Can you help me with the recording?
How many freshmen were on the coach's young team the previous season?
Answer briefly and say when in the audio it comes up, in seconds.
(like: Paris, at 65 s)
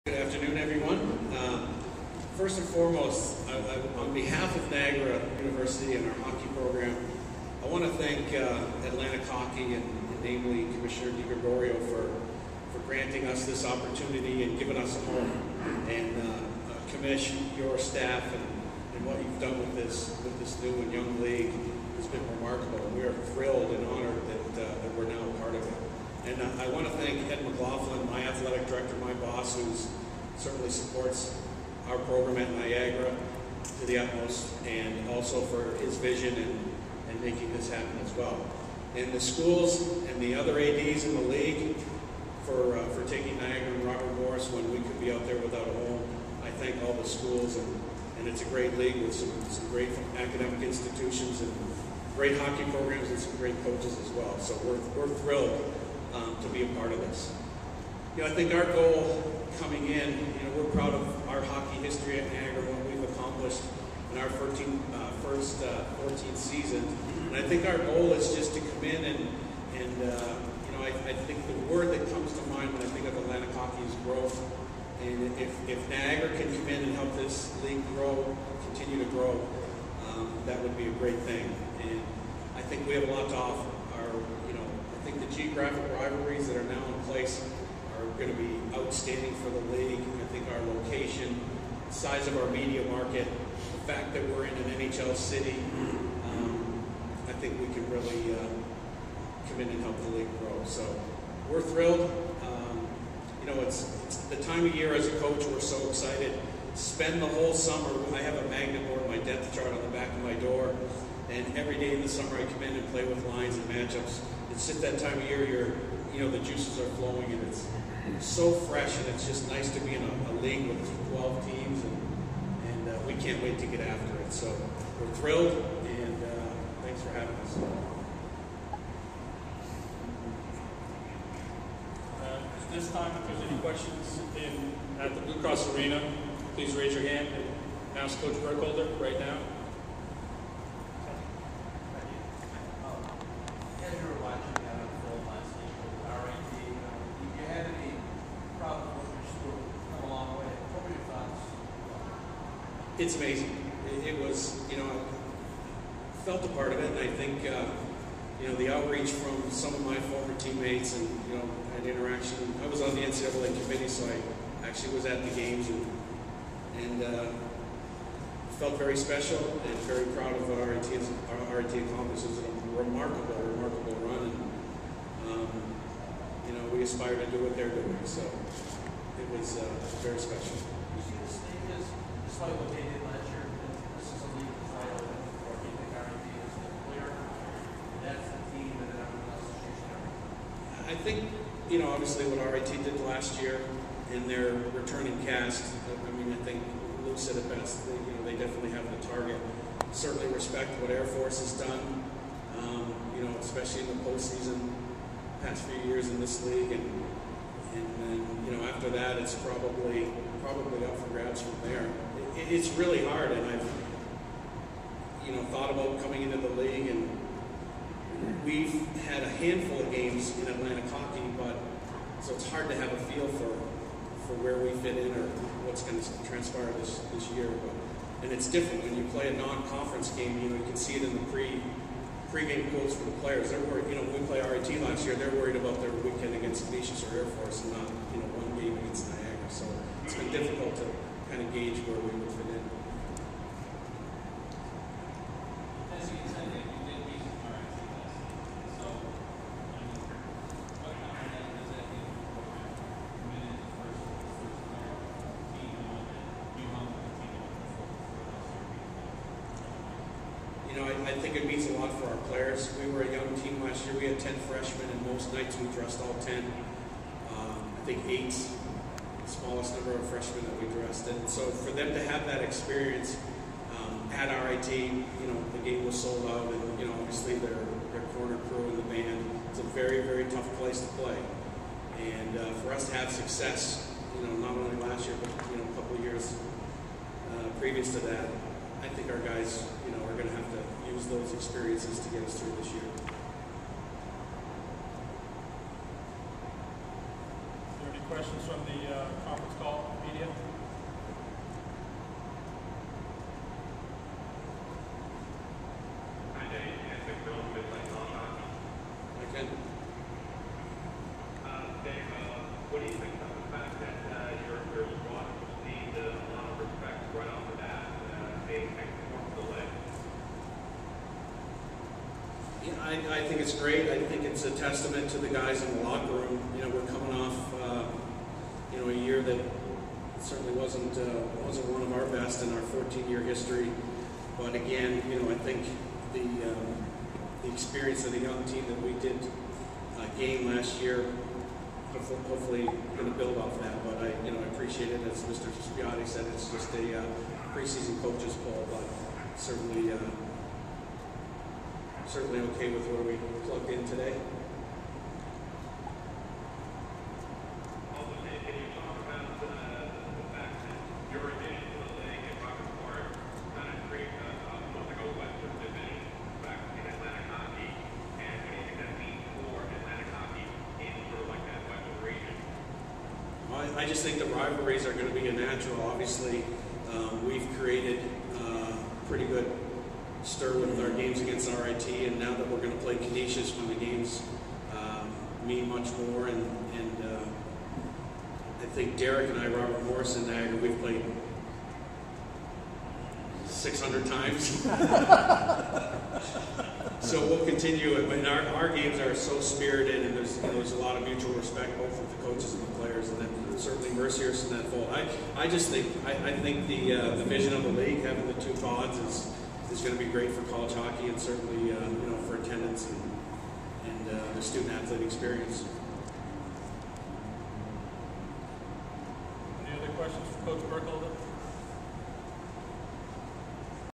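10, at 264 s.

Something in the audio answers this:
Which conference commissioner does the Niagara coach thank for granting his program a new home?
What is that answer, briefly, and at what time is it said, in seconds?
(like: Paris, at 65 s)
DiGregorio, at 10 s.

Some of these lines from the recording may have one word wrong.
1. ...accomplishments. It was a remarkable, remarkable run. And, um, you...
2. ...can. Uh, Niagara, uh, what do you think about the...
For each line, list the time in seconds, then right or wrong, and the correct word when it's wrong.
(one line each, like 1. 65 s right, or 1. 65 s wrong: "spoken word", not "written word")
1. 171 s right
2. 309 s wrong: "Dave", not "Niagara".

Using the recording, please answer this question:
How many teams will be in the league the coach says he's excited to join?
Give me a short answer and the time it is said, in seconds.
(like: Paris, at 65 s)
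12, at 121 s.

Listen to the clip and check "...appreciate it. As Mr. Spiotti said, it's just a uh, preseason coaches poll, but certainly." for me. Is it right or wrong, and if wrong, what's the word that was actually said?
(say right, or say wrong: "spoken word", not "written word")
right.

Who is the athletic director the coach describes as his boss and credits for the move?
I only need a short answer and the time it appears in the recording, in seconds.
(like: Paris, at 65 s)
Ed McLaughlin, at 27 s.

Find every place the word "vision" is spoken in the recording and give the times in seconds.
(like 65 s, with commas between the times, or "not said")
35 s, 407 s.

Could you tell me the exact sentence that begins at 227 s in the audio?
But, and it's different when you play a non-conference game.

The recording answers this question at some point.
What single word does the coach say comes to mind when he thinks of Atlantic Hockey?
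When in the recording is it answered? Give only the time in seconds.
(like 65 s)
74 s.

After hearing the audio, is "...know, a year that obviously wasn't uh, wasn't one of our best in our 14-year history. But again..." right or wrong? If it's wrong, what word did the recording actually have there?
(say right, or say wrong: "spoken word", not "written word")
wrong: "certainly", not "obviously".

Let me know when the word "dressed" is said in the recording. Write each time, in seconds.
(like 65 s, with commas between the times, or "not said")
265 s, 270 s.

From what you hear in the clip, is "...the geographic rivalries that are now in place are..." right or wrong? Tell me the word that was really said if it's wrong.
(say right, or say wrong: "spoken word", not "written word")
right.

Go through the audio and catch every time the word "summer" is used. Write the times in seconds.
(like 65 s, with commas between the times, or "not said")
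107 s, 112 s.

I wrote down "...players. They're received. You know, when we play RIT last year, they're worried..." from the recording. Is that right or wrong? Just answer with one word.
wrong.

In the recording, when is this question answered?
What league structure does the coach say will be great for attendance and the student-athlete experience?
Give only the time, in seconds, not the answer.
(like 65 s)
408 s.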